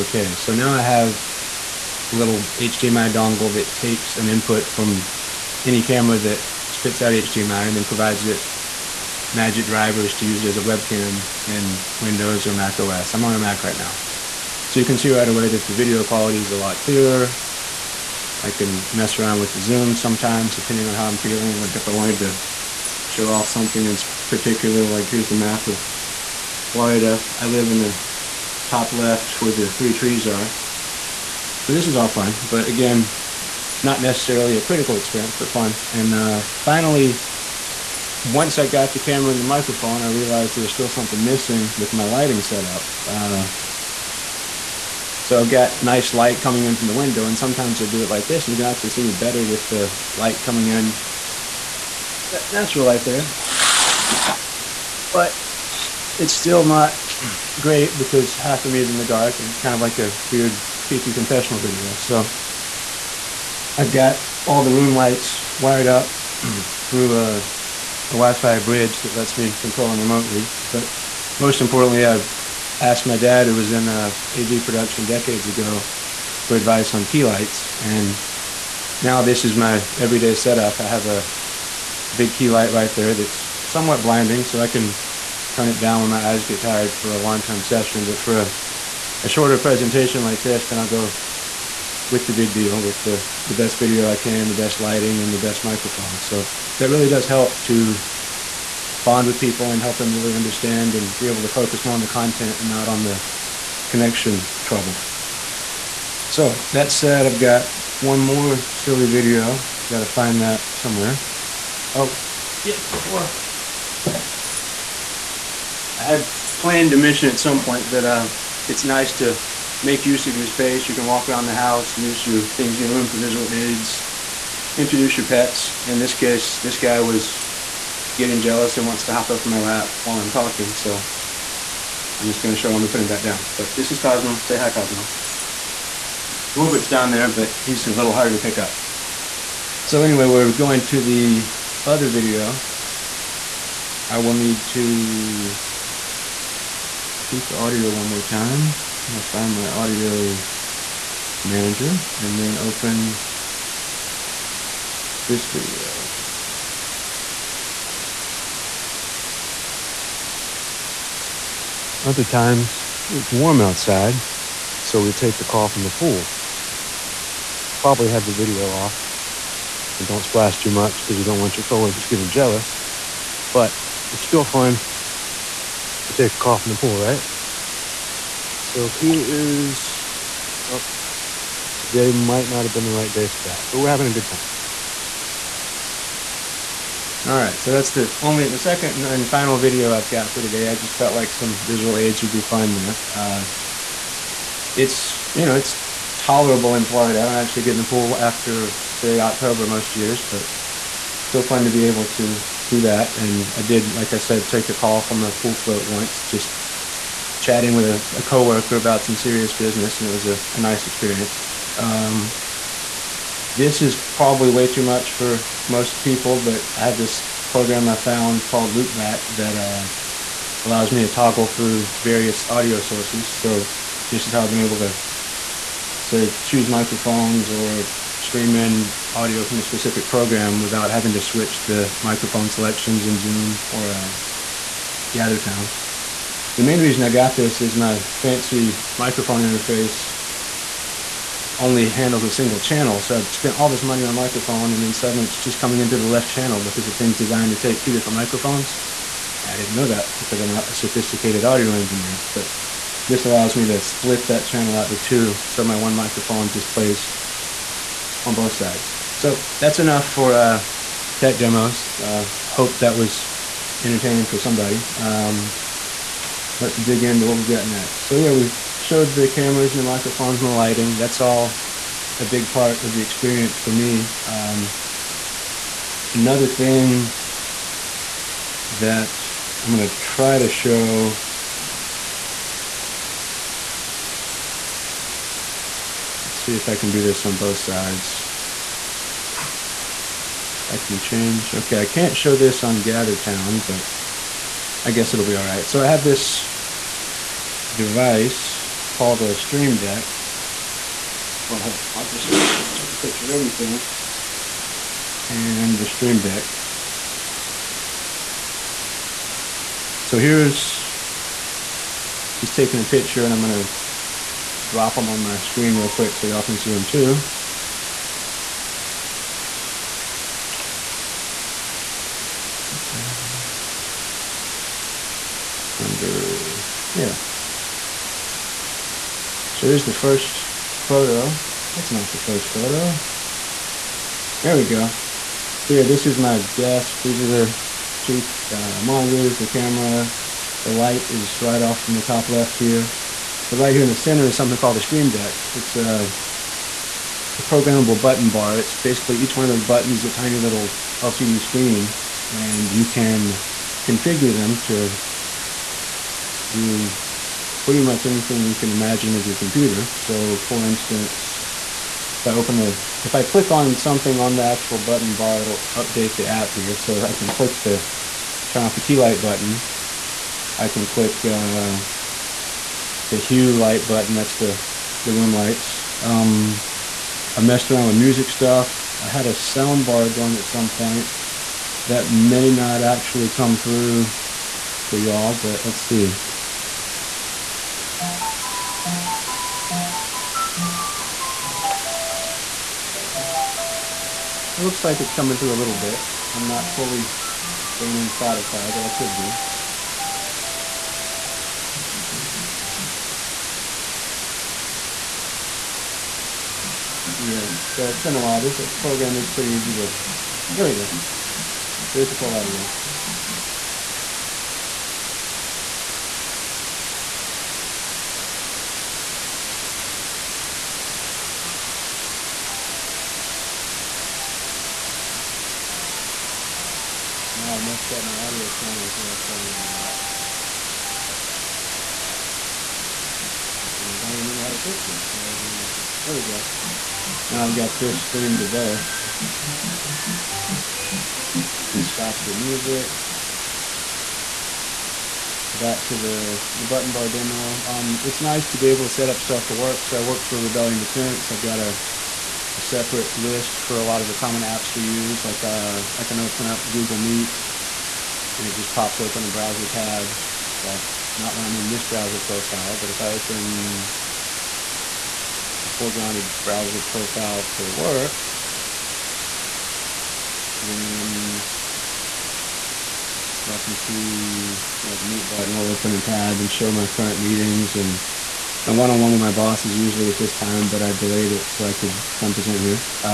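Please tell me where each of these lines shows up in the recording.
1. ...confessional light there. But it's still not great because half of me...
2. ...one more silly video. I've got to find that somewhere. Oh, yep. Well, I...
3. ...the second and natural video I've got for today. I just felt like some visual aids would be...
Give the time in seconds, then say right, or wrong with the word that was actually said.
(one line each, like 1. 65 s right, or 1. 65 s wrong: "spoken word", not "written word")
1. 52 s wrong: "natural", not "confessional"
2. 107 s right
3. 188 s wrong: "final", not "natural".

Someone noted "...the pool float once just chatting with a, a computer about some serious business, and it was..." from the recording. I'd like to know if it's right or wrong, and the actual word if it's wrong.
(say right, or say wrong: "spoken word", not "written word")
wrong: "coworker", not "computer".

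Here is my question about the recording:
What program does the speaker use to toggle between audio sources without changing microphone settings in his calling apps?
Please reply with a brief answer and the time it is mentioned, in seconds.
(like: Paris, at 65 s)
Loopback, at 218 s.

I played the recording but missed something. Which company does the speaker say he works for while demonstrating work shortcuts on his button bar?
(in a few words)
Rebellion Defense.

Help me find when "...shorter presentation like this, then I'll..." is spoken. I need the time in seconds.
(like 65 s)
89 s.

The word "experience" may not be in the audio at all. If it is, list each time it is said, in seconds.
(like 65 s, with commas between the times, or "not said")
34 s, 210 s, 273 s.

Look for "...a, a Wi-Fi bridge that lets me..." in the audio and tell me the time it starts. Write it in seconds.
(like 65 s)
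67 s.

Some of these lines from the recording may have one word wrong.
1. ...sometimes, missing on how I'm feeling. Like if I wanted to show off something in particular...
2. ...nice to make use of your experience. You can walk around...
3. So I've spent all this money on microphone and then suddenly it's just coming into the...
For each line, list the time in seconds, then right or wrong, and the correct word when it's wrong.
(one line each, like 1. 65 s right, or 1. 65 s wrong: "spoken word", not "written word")
1. 19 s wrong: "depending", not "missing"
2. 118 s wrong: "space", not "experience"
3. 243 s right.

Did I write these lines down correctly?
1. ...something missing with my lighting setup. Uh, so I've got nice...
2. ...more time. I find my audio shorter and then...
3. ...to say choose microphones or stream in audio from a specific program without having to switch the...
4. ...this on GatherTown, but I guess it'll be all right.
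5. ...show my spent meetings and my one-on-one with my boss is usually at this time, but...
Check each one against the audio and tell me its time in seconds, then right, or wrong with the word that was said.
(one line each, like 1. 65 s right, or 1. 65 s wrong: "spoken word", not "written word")
1. 40 s right
2. 148 s wrong: "manager", not "shorter"
3. 224 s right
4. 292 s right
5. 476 s wrong: "current", not "spent".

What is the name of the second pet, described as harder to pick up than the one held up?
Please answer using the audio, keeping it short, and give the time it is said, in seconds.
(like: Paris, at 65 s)
Rupert, at 136 s.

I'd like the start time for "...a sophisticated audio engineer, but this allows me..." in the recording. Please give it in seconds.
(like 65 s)
250 s.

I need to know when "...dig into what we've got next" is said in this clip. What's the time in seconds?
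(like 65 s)
266 s.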